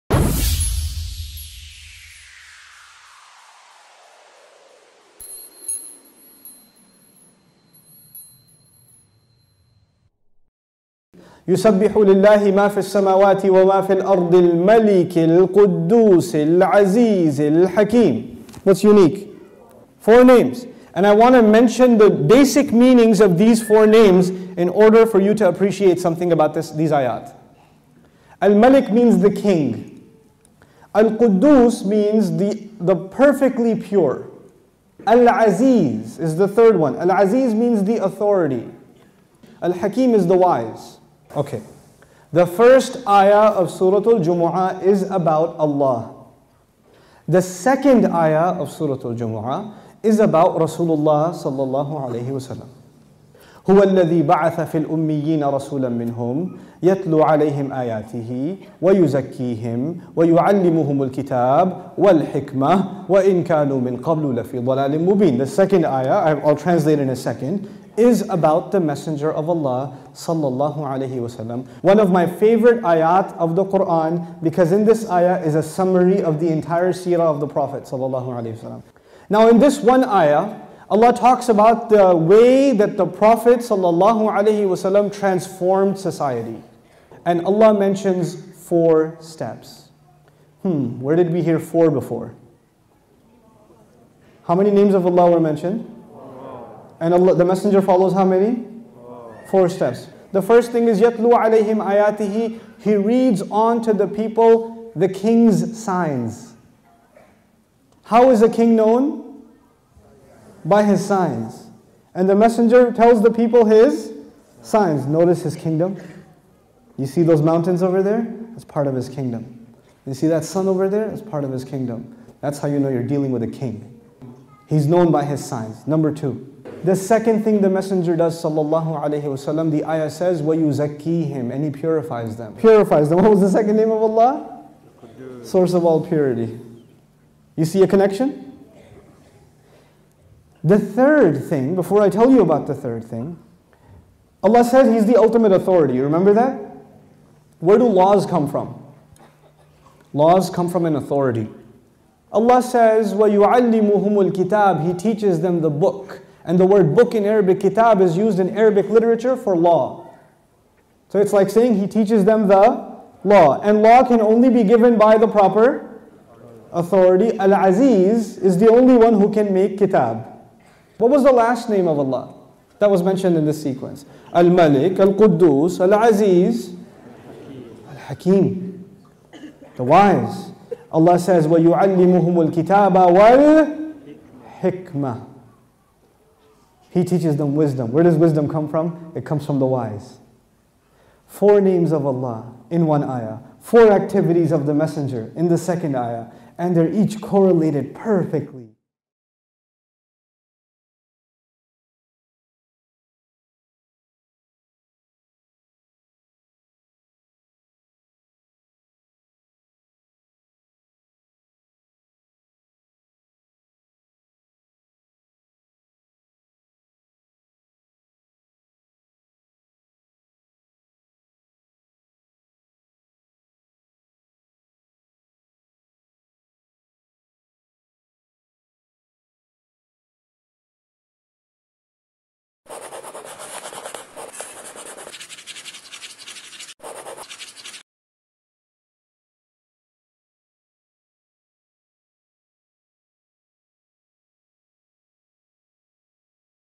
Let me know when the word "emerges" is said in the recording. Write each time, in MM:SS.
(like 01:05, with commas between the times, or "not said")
not said.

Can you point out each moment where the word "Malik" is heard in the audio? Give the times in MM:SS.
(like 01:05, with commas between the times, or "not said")
00:28, 02:54.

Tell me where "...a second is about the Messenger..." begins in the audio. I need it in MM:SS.
01:07.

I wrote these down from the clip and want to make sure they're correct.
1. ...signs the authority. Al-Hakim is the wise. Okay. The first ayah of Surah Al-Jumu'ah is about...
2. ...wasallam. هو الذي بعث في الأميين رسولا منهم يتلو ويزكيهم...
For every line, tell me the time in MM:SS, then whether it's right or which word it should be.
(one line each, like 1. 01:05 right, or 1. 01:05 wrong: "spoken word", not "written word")
1. 00:37 wrong: "means", not "signs"
2. 00:52 wrong: "عليهم", not "ويزكيهم".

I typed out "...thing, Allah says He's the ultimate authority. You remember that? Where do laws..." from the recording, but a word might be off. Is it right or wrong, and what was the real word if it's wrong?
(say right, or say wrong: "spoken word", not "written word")
right.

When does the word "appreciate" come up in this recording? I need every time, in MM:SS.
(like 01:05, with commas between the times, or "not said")
00:25.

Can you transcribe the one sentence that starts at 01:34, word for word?
How many names of Allah were mentioned?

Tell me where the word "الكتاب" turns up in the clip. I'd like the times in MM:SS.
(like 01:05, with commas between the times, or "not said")
01:01, 02:34, 03:02.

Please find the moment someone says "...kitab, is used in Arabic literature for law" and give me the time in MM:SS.
02:37.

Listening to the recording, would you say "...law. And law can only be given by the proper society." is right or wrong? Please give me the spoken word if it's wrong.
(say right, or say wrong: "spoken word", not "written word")
wrong: "authority", not "society".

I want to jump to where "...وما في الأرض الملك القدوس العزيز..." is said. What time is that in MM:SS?
00:13.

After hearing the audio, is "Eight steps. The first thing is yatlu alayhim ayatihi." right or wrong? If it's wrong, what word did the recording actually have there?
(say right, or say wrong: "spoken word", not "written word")
wrong: "Four", not "Eight".